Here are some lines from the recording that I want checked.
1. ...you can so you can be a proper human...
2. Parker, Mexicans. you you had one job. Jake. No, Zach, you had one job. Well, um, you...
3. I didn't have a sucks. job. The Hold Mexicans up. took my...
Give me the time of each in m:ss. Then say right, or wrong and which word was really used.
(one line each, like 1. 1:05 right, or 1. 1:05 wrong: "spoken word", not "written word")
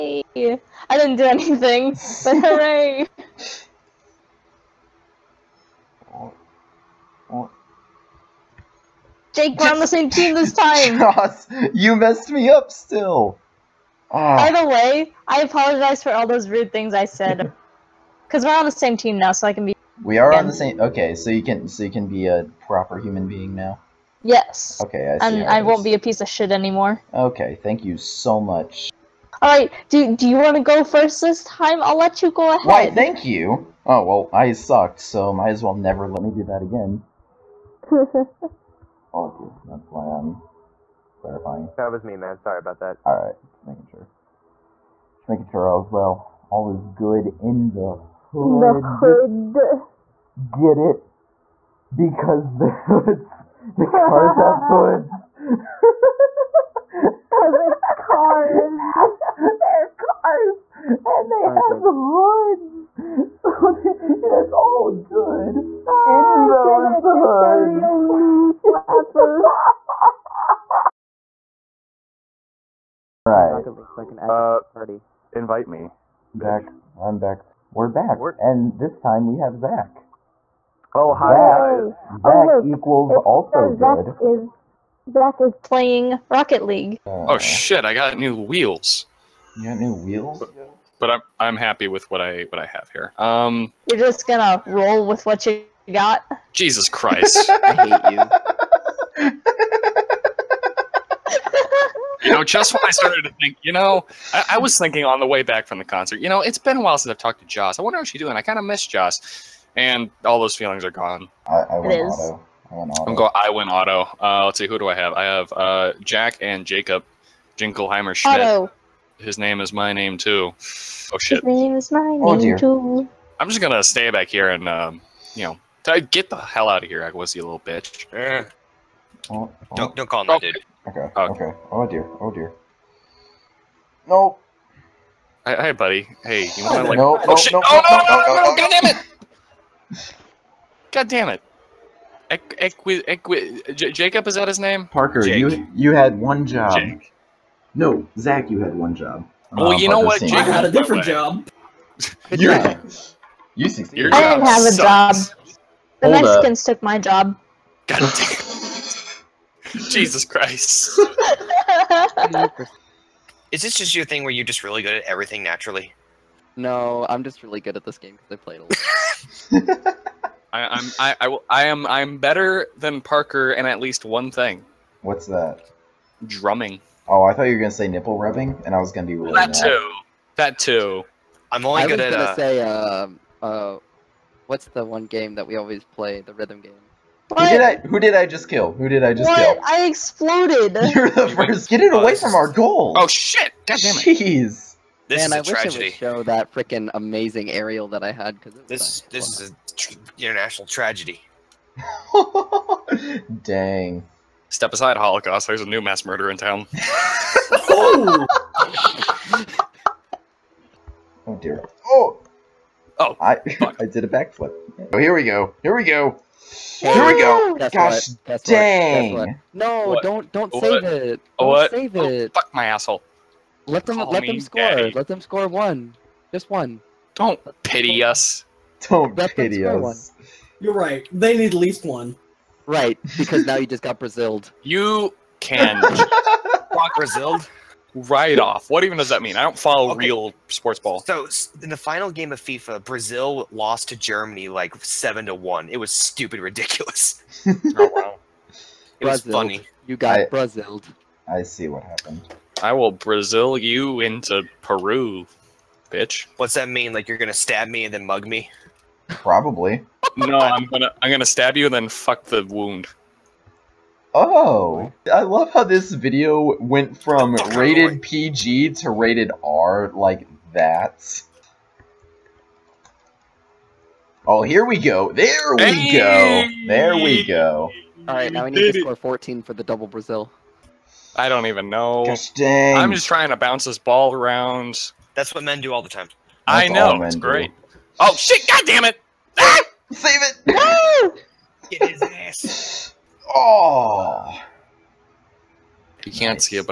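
1. 0:21 right
2. 2:24 wrong: "Jake", not "Mexicans"
3. 2:34 right.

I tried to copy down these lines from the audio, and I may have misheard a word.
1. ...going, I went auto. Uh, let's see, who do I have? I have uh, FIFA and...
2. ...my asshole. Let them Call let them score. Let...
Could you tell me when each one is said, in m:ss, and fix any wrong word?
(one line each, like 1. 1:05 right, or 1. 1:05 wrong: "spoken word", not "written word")
1. 1:53 wrong: "Jack", not "FIFA"
2. 3:42 right.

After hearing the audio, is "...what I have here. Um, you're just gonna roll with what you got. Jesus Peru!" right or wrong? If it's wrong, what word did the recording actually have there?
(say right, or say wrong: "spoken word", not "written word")
wrong: "Christ", not "Peru".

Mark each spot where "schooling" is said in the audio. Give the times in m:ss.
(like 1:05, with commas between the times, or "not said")
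not said.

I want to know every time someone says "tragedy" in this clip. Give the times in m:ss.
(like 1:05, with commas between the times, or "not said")
3:15, 3:20.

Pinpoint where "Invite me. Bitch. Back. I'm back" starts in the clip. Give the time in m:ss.
1:15.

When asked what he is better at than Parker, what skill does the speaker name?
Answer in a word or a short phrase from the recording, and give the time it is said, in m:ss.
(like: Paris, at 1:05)
Drumming, at 2:56.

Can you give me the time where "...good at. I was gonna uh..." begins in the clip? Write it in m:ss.
3:01.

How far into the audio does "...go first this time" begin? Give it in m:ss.
0:30.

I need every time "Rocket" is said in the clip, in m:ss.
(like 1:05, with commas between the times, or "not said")
1:13, 1:26.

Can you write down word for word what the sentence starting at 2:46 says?
No, I'm just really good at this game because I played a lot.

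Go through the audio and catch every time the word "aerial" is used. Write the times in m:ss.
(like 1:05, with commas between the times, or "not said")
3:17.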